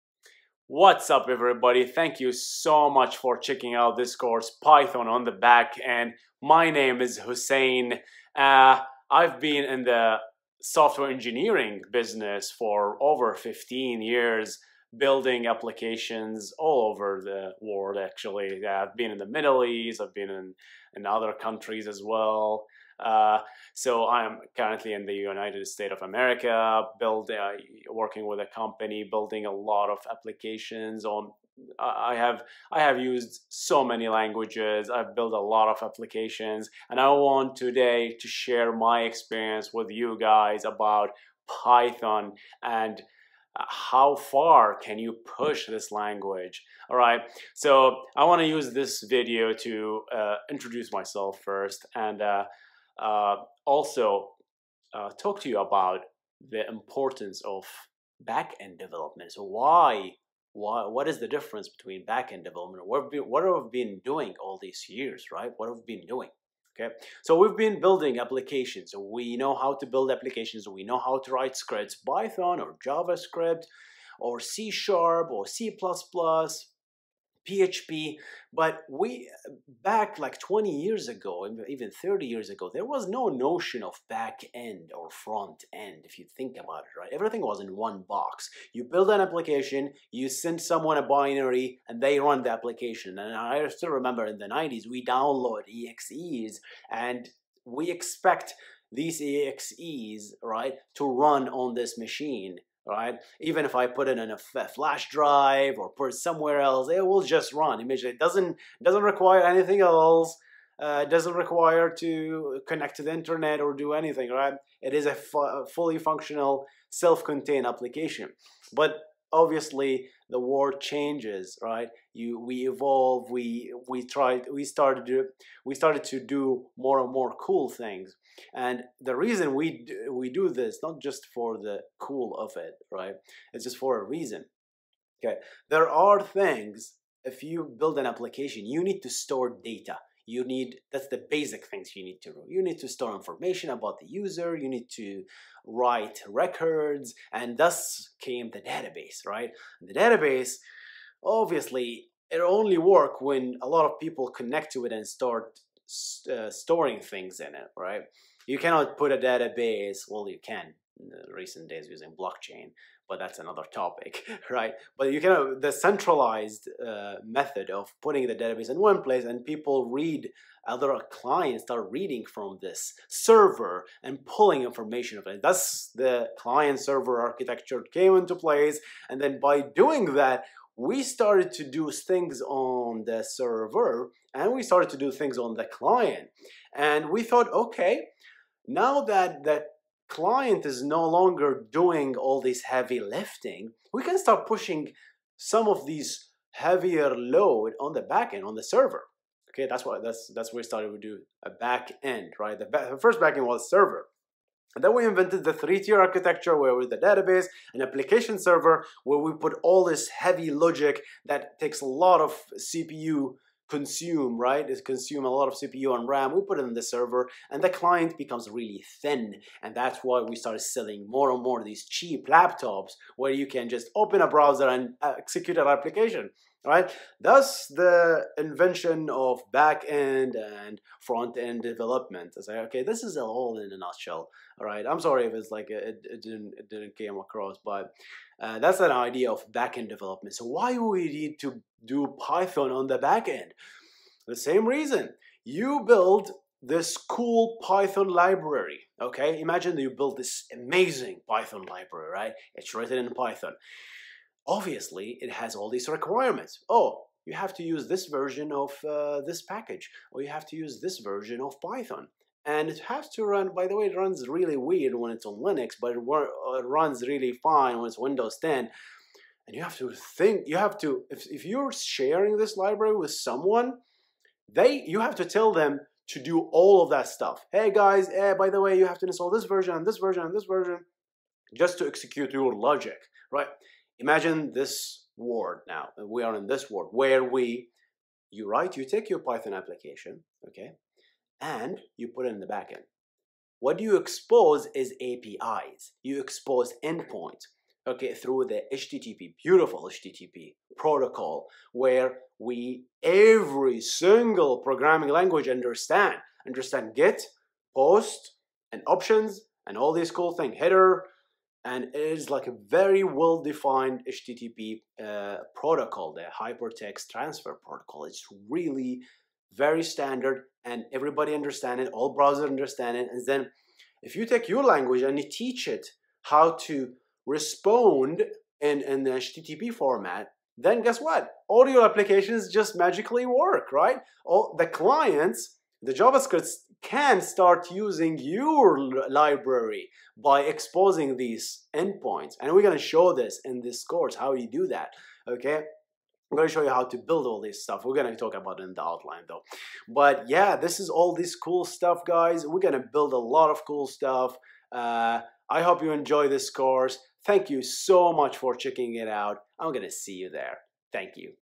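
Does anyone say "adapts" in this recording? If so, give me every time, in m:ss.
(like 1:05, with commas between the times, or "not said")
not said.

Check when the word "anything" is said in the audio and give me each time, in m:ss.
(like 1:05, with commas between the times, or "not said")
1:49, 1:53.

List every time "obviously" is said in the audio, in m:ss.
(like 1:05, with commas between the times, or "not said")
1:59, 2:31, 4:14.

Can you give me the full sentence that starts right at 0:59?
So why, why, what is the difference between back-end development?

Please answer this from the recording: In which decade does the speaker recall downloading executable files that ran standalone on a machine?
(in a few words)
the 90s.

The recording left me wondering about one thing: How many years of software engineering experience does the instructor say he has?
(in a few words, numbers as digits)
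15.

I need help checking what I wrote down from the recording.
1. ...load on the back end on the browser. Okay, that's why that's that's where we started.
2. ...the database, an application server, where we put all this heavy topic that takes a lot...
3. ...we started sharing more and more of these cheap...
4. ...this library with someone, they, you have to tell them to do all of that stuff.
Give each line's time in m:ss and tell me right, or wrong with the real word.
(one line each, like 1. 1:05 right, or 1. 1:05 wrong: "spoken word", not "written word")
1. 3:17 wrong: "server", not "browser"
2. 3:26 wrong: "logic", not "topic"
3. 3:40 wrong: "selling", not "sharing"
4. 4:32 right.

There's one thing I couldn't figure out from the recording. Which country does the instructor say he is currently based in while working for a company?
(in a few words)
United States of America.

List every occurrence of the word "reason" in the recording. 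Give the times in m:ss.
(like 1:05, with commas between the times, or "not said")
2:09, 2:14, 4:04.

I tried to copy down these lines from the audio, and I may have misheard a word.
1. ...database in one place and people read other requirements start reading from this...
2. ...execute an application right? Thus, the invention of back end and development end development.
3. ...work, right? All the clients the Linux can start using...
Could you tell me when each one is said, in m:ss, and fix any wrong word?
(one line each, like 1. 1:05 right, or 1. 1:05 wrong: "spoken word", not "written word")
1. 2:48 wrong: "clients", not "requirements"
2. 3:45 wrong: "front", not "development"
3. 5:33 wrong: "JavaScript", not "Linux".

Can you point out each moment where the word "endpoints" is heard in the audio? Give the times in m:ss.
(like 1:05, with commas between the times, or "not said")
4:56, 5:41.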